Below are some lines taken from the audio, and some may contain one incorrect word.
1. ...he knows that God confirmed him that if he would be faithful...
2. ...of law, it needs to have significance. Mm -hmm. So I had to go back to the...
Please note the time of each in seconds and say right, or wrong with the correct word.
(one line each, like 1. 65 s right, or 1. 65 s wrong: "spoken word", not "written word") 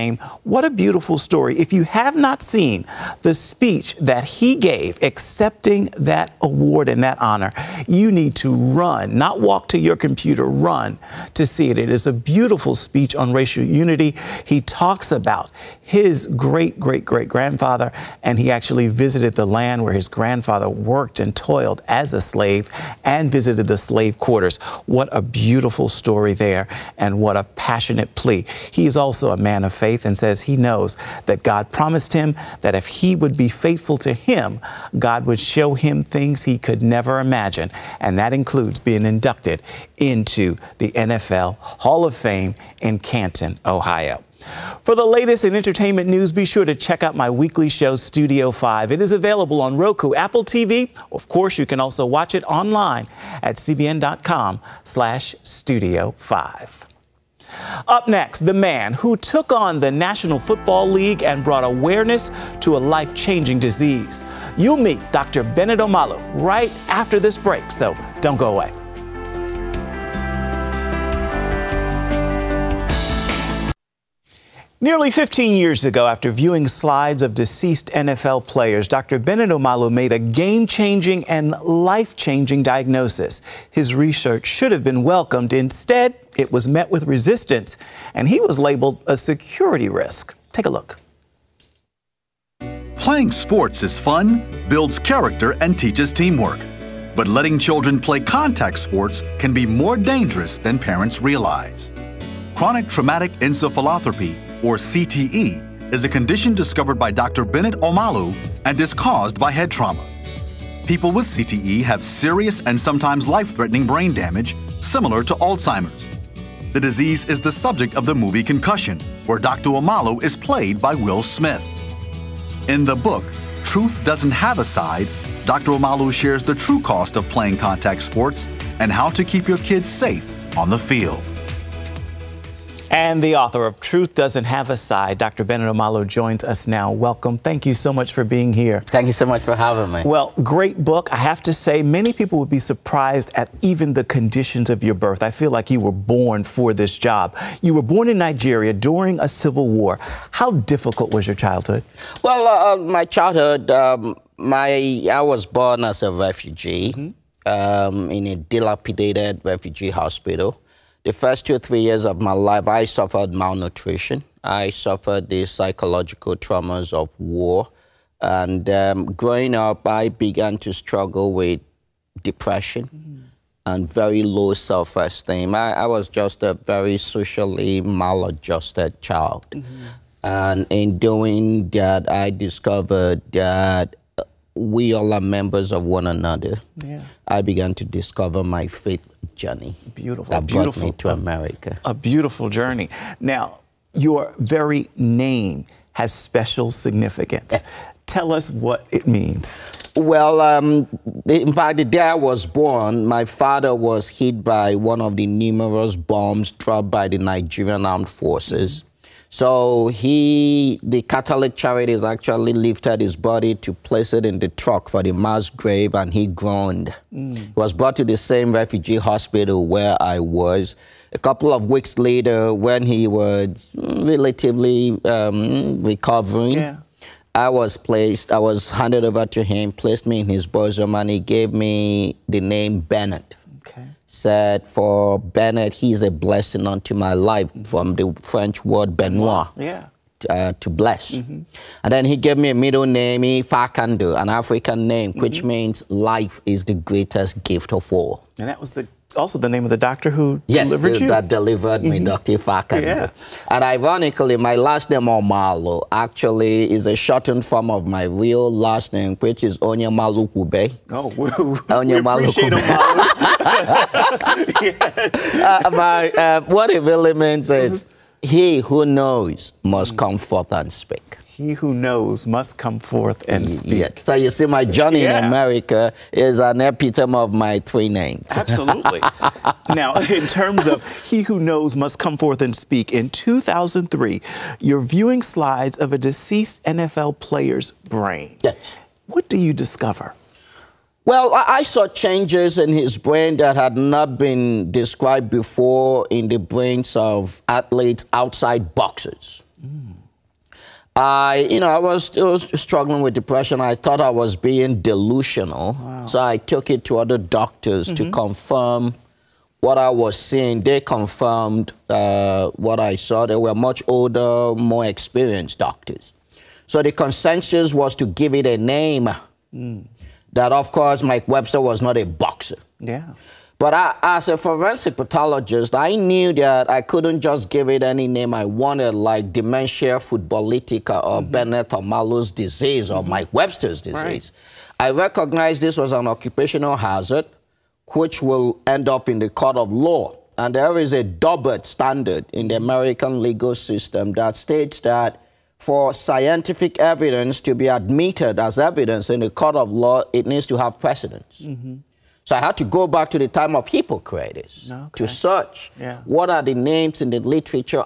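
1. 30 s wrong: "promised", not "confirmed"
2. 349 s wrong: "precedence", not "significance".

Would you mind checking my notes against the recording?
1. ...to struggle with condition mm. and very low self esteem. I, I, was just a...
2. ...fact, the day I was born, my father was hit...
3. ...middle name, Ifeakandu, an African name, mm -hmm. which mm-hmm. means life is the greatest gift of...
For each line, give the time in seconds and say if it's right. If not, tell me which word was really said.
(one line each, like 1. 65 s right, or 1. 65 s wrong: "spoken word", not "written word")
1. 170 s wrong: "depression", not "condition"
2. 201 s right
3. 242 s right.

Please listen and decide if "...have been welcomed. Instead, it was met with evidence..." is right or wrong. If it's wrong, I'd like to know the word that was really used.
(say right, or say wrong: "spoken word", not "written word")
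wrong: "resistance", not "evidence".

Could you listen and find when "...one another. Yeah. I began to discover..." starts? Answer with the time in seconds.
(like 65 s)
185 s.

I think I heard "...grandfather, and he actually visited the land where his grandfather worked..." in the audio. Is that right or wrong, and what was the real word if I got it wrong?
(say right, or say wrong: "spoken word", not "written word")
right.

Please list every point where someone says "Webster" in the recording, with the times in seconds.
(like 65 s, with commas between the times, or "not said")
321 s, 333 s.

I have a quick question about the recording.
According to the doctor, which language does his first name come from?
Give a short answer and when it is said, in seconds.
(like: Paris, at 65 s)
French, at 238 s.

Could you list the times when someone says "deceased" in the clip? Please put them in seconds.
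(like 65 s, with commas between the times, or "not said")
77 s, 285 s.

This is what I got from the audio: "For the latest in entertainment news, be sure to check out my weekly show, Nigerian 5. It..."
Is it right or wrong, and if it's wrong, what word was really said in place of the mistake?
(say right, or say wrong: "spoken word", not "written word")
wrong: "Studio", not "Nigerian".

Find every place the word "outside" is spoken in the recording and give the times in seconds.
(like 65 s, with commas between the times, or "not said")
298 s.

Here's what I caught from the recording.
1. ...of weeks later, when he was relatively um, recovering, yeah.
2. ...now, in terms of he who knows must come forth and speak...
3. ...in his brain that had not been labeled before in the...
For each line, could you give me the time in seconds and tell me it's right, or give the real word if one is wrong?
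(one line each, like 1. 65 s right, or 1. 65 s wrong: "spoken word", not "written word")
1. 221 s right
2. 279 s right
3. 292 s wrong: "described", not "labeled".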